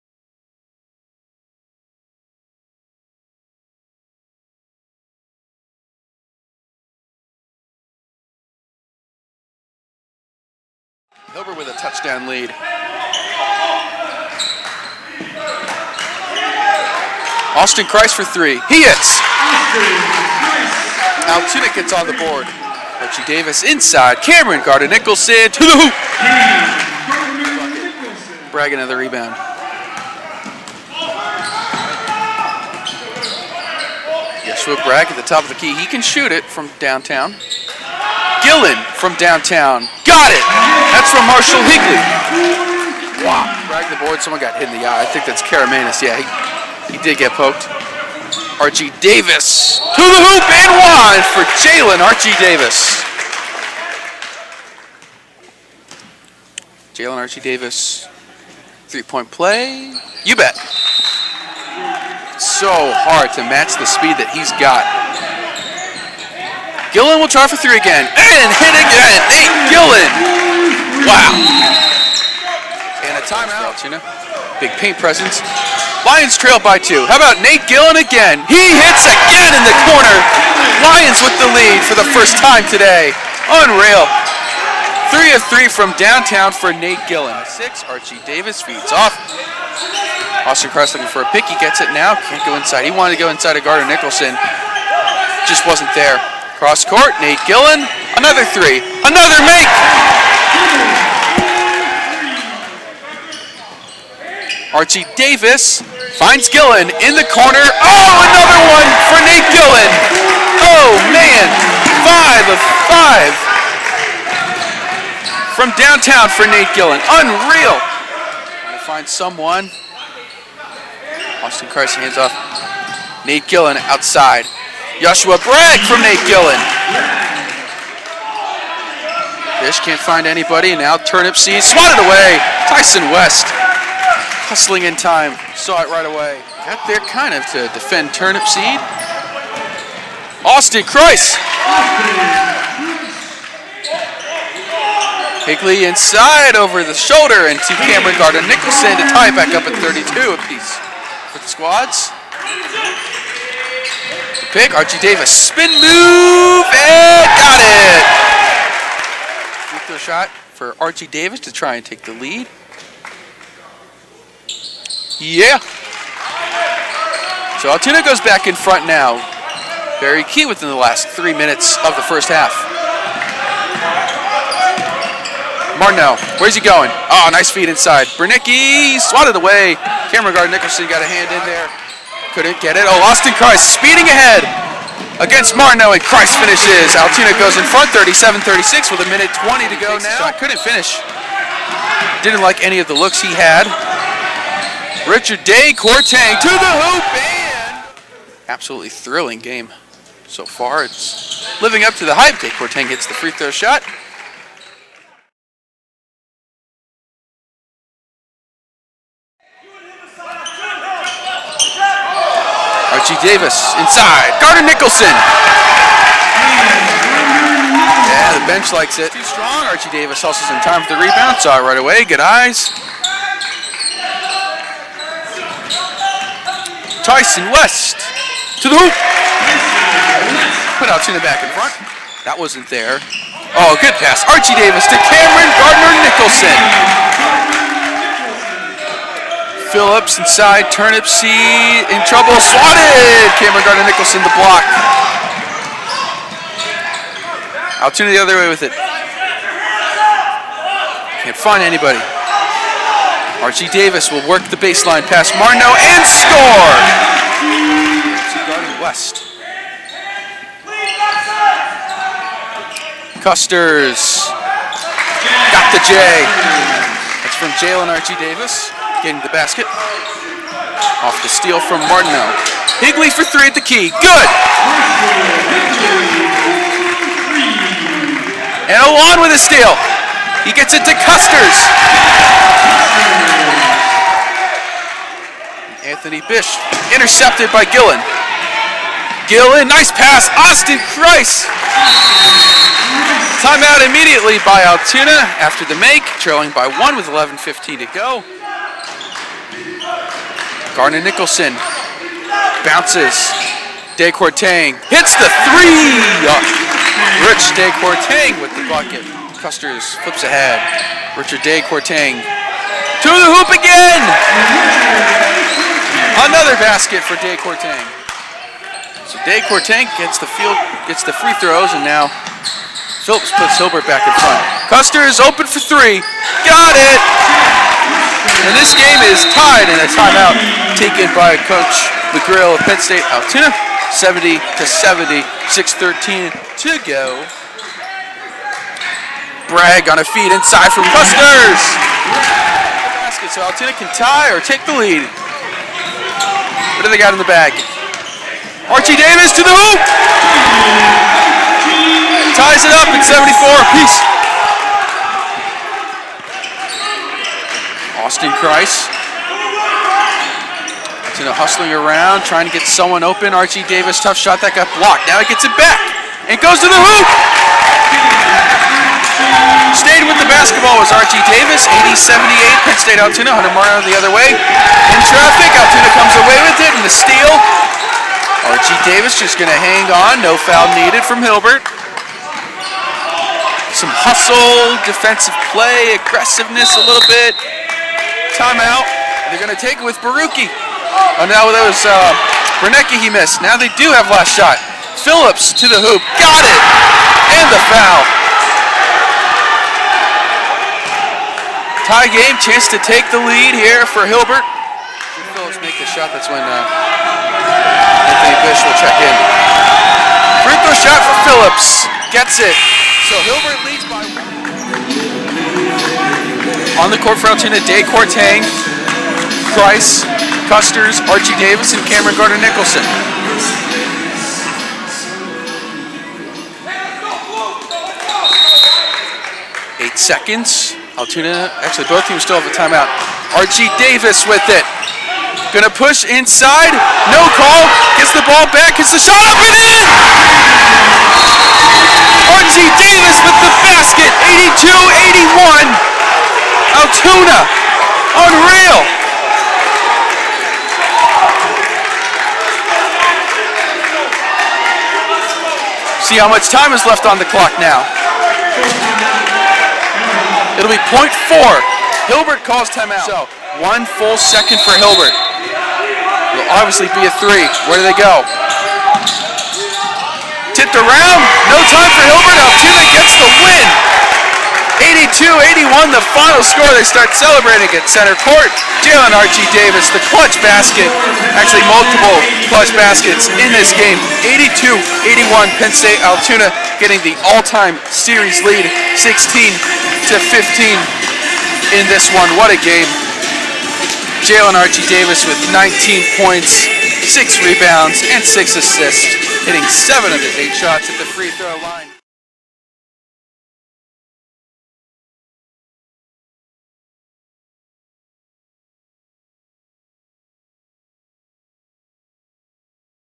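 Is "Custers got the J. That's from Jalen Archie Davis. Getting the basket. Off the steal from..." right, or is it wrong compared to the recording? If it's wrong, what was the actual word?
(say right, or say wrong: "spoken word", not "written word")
right.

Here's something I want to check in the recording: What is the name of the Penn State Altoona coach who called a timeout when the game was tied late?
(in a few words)
McGrill.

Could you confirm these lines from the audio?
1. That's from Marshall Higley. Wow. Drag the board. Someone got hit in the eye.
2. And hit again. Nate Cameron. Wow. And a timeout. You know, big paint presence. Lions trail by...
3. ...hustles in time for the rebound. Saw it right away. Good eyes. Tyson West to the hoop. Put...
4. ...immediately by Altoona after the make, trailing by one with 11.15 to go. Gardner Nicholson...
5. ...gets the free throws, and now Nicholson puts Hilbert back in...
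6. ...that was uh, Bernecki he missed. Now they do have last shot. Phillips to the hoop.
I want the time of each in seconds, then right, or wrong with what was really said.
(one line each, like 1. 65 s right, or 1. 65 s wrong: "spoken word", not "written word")
1. 40 s right
2. 68 s wrong: "Gillen", not "Cameron"
3. 220 s right
4. 293 s right
5. 320 s wrong: "Phillips", not "Nicholson"
6. 391 s right.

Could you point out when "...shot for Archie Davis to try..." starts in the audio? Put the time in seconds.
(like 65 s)
159 s.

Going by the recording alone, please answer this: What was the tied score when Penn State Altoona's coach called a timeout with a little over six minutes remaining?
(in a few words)
70 to 70.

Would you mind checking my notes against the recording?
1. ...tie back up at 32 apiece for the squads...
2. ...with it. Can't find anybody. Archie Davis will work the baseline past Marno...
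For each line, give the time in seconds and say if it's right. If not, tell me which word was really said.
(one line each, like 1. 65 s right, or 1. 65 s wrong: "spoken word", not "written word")
1. 149 s right
2. 248 s right.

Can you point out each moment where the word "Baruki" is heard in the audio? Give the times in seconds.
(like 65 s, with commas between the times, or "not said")
390 s.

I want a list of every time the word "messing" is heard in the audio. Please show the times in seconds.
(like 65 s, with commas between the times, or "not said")
not said.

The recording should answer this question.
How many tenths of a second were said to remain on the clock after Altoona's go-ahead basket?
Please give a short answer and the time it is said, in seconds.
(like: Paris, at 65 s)
point four, at 460 s.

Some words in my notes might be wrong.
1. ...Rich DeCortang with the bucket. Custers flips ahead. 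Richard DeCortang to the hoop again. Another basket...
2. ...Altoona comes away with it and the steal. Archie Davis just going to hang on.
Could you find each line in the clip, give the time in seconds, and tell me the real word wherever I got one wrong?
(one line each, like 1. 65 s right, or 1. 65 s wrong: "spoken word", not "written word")
1. 307 s right
2. 375 s right.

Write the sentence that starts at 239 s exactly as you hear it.
Phillips inside, Turnipseed in trouble, swatted.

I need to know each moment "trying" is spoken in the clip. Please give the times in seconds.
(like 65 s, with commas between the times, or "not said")
117 s, 362 s.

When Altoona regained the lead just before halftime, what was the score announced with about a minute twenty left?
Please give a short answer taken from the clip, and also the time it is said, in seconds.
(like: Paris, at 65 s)
37-36, at 187 s.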